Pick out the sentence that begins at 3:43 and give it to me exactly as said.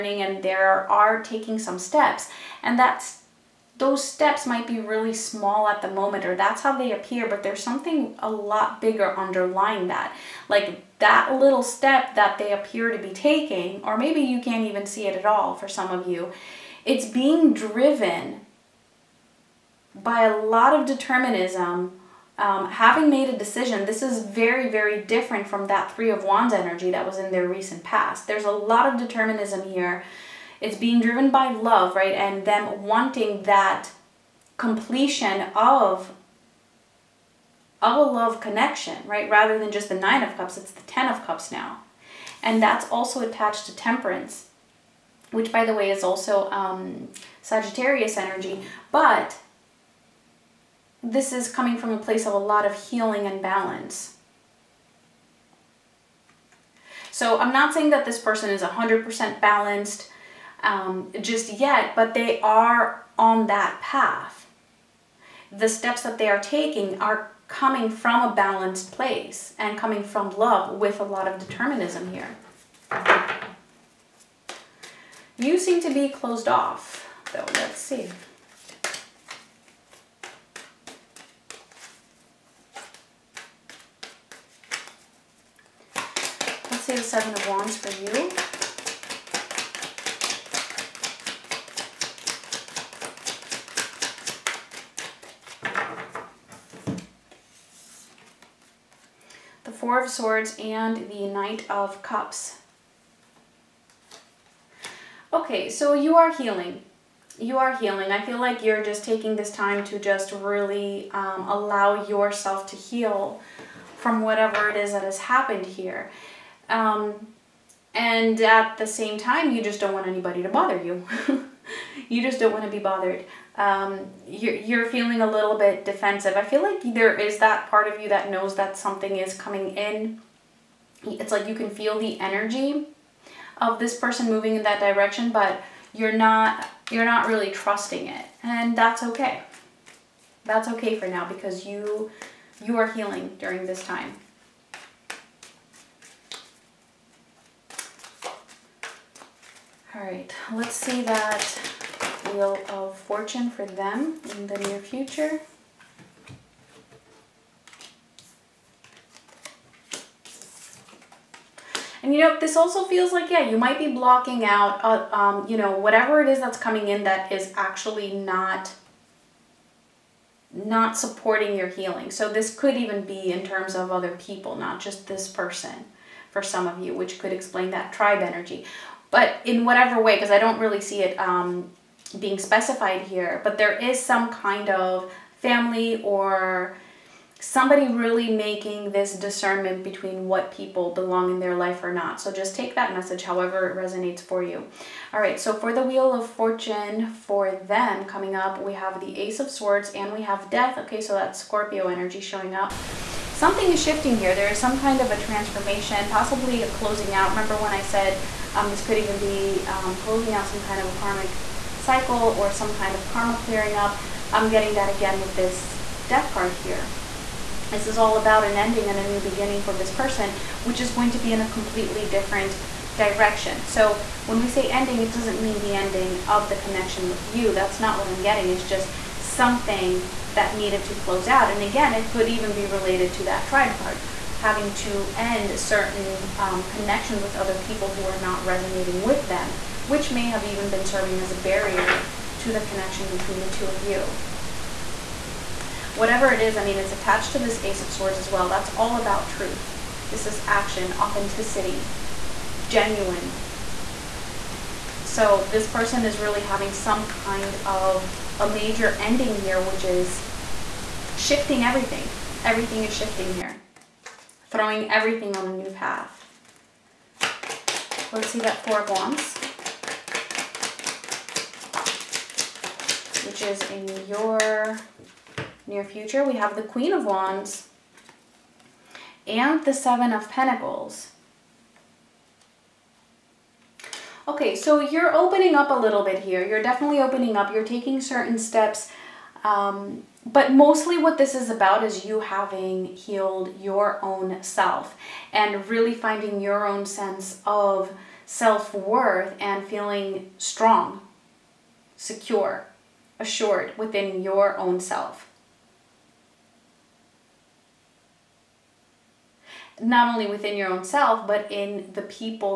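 So when we say ending, it doesn't mean the ending of the connection with you.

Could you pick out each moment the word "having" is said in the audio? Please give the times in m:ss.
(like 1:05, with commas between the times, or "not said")
0:22, 3:54, 4:16, 4:52.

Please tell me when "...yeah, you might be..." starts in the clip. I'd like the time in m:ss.
2:43.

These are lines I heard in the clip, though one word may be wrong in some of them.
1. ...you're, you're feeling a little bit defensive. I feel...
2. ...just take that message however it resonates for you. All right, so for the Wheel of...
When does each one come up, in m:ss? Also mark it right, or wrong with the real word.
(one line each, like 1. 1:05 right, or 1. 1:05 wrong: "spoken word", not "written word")
1. 2:04 right
2. 3:12 right.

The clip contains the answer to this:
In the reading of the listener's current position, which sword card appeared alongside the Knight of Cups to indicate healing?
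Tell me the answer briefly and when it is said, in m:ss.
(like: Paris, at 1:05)
Four of Swords, at 1:39.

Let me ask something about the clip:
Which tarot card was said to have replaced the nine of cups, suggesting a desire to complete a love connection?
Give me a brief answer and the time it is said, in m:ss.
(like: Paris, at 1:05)
Ten of Cups, at 0:40.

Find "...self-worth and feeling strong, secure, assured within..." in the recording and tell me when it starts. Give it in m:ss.
4:58.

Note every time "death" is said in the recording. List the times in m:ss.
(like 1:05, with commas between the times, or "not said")
3:20, 3:36.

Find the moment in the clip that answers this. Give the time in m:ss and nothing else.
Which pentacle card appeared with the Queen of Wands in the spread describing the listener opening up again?
4:39.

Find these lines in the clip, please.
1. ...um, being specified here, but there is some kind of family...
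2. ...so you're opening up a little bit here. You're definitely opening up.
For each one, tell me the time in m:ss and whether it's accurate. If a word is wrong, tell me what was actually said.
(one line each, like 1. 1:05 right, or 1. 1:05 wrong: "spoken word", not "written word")
1. 3:01 right
2. 4:44 right.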